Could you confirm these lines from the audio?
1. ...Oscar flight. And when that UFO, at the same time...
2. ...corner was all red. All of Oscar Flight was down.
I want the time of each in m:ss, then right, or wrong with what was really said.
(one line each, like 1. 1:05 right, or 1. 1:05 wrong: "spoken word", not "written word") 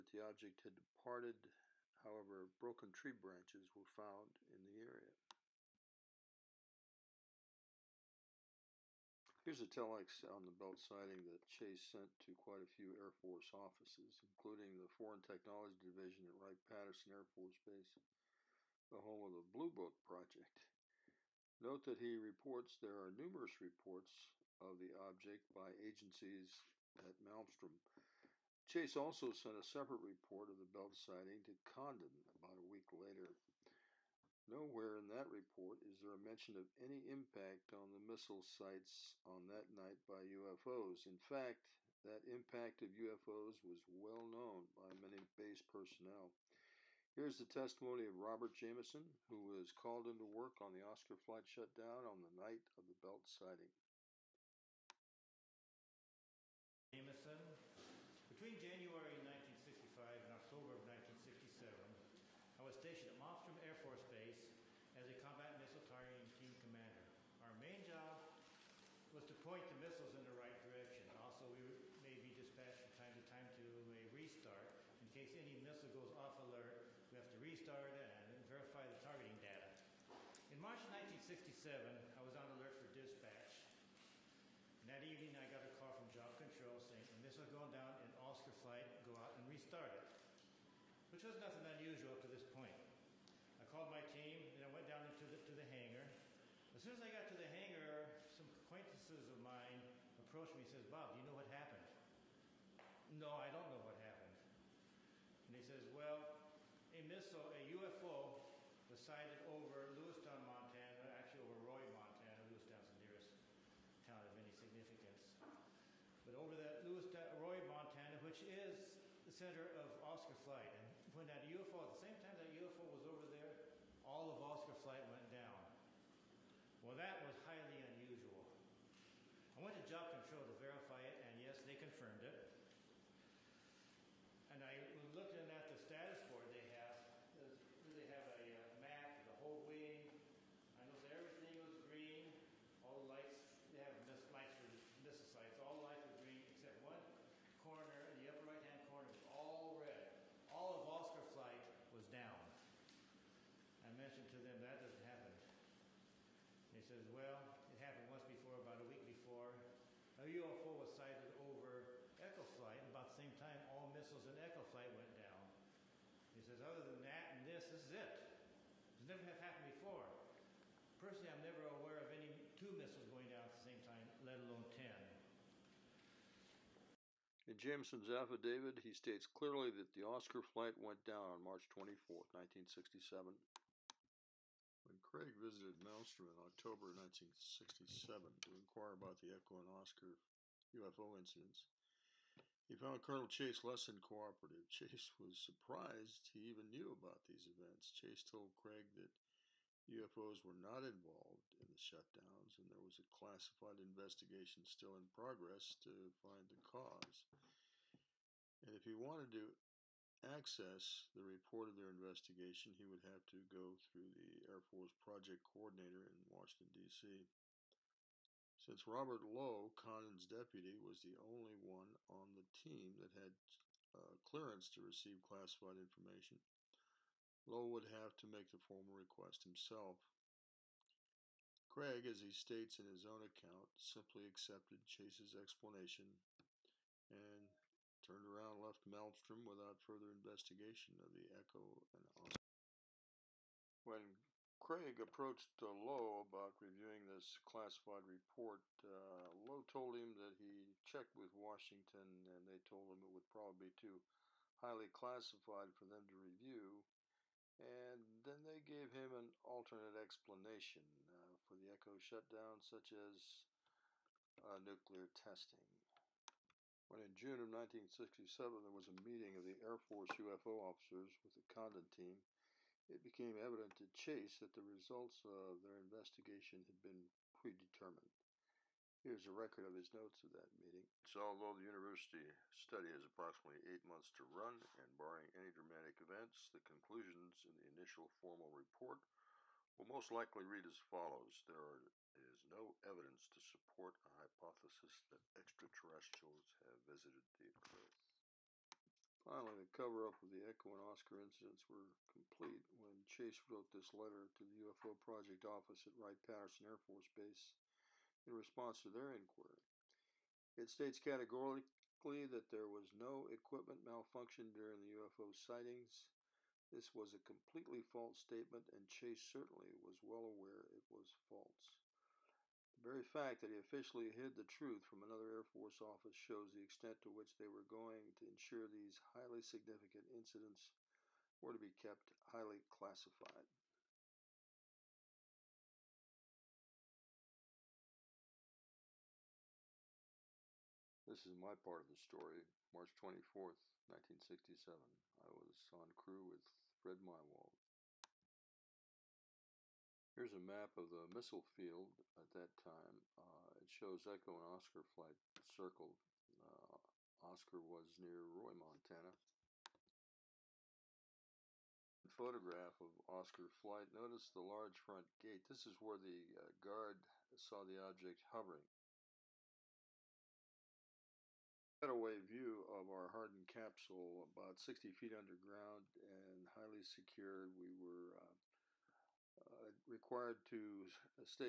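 1. 2:00 right
2. 2:28 right.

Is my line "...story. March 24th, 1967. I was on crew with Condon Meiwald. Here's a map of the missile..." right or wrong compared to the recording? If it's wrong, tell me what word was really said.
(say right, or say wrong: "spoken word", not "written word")
wrong: "Fred", not "Condon".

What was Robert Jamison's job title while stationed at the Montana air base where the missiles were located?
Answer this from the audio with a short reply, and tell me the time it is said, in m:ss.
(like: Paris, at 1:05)
combat missile targeting team commander, at 1:05.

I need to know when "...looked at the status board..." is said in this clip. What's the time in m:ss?
2:15.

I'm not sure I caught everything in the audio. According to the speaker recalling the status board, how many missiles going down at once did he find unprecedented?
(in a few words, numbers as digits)
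10.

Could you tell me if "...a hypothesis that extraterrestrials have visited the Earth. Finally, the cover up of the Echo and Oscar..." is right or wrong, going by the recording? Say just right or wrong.
right.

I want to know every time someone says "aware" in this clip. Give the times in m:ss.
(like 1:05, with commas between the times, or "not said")
2:51, 5:20.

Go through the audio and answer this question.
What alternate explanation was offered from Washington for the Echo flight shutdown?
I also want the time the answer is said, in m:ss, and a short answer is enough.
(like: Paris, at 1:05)
nuclear testing, at 4:24.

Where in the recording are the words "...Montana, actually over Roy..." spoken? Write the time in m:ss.
1:50.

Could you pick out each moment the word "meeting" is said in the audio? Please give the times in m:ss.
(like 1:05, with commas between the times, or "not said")
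4:29, 4:40.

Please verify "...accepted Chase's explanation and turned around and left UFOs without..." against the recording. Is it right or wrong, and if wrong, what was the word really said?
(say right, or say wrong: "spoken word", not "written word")
wrong: "Malmstrom", not "UFOs".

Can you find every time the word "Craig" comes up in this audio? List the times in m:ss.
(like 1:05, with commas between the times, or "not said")
3:04, 3:18, 3:51, 4:04.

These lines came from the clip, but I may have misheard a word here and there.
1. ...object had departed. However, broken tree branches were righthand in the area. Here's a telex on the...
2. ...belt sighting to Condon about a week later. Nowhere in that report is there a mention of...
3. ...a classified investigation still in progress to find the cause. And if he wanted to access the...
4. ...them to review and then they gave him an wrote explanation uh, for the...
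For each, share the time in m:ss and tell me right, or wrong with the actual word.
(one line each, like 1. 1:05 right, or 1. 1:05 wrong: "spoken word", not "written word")
1. 0:00 wrong: "found", not "righthand"
2. 0:30 right
3. 3:22 right
4. 4:15 wrong: "alternate", not "wrote".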